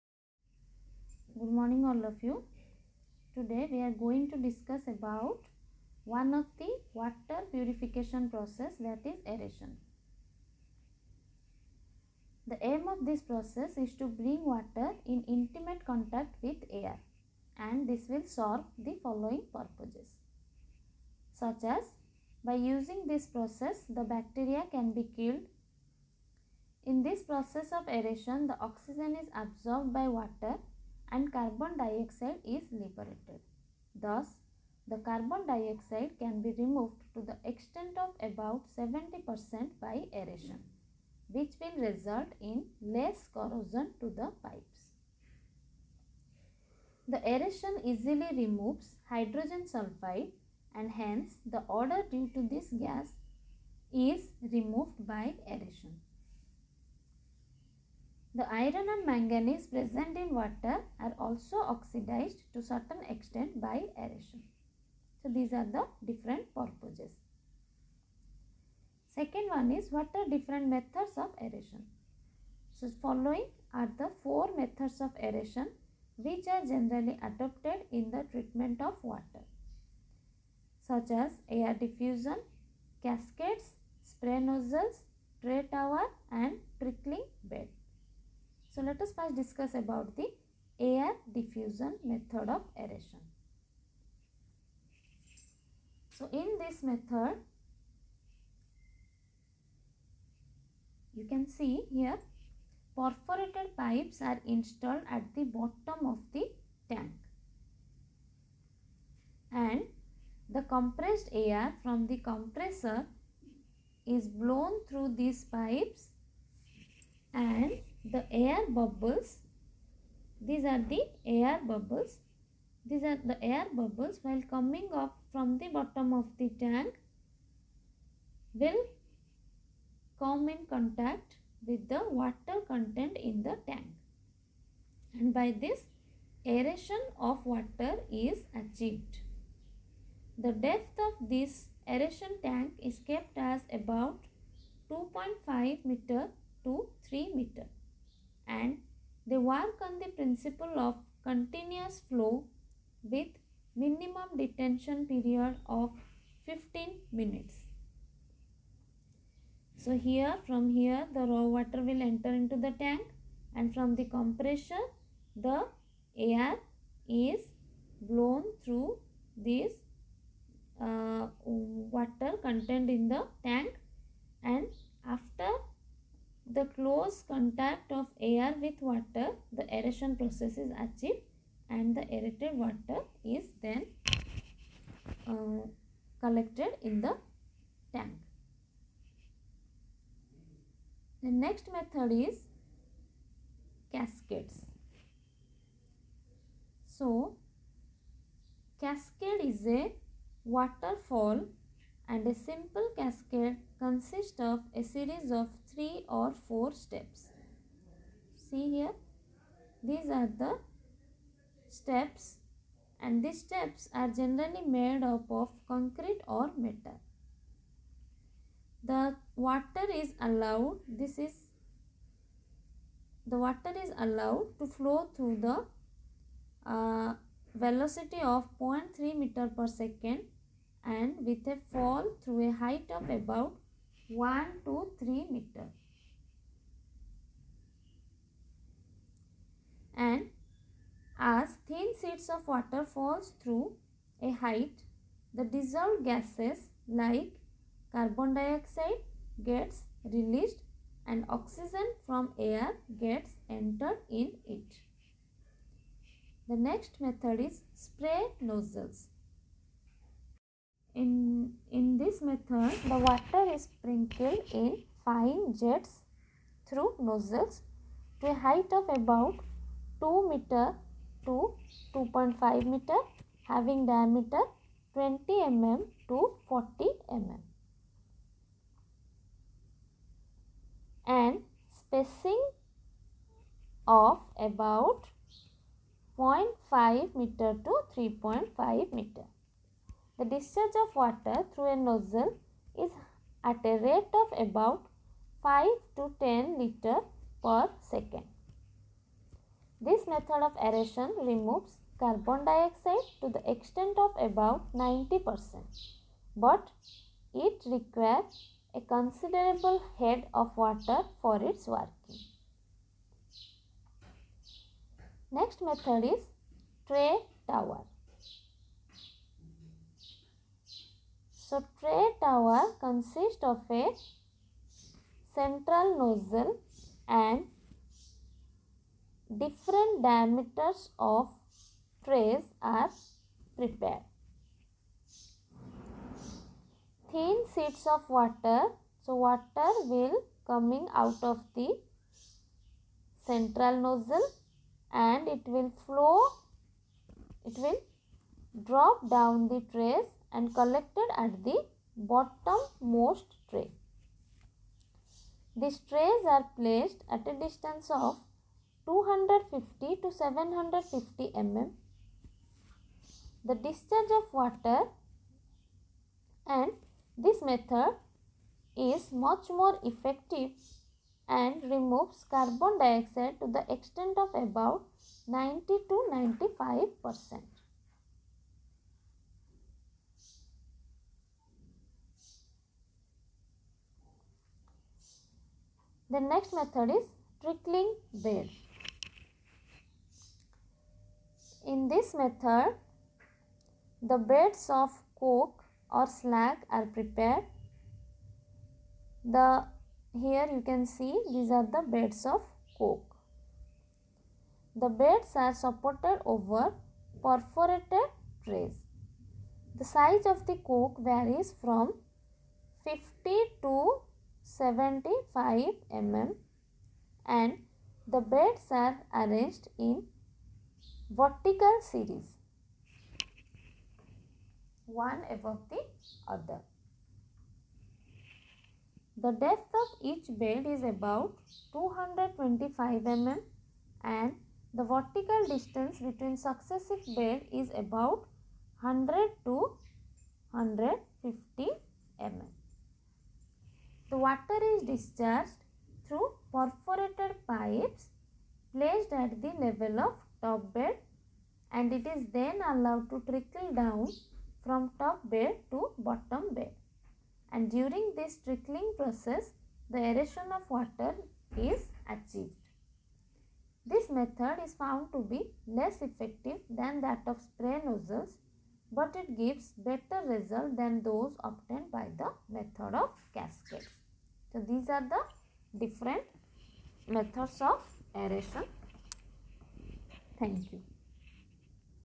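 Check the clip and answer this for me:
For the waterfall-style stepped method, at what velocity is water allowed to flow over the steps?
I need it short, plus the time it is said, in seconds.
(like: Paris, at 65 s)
0.3 meter per second, at 228 s.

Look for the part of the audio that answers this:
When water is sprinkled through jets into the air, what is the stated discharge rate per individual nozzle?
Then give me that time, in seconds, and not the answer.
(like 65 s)
295 s.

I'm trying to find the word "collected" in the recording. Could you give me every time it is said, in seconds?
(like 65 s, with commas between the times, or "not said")
186 s, 350 s.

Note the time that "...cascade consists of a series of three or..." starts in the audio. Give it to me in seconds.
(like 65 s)
202 s.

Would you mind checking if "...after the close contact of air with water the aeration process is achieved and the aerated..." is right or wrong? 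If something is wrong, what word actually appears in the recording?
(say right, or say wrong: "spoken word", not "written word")
right.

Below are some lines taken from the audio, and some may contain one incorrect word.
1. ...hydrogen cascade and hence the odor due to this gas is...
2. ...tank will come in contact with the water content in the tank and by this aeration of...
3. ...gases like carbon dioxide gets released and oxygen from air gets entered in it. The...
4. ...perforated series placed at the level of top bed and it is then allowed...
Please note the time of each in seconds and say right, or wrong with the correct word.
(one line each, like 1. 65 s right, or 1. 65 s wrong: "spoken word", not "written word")
1. 49 s wrong: "sulfide", not "cascade"
2. 126 s right
3. 246 s right
4. 446 s wrong: "pipes", not "series".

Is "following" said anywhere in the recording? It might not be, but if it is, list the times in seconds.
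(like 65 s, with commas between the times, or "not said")
19 s, 73 s.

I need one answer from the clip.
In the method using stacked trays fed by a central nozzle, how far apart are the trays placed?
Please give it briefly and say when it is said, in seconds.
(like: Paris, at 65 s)
250 to 750 mm, at 358 s.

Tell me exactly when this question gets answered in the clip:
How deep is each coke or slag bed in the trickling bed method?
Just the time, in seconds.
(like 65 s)
431 s.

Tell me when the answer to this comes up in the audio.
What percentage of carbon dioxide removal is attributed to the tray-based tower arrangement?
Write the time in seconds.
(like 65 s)
375 s.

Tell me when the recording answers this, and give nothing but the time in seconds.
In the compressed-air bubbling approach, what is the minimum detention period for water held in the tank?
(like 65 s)
156 s.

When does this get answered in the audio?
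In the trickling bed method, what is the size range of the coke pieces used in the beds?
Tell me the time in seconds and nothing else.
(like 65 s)
412 s.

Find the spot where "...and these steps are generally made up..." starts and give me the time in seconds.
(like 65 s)
213 s.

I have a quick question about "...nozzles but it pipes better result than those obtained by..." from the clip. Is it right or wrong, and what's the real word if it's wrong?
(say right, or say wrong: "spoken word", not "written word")
wrong: "gives", not "pipes".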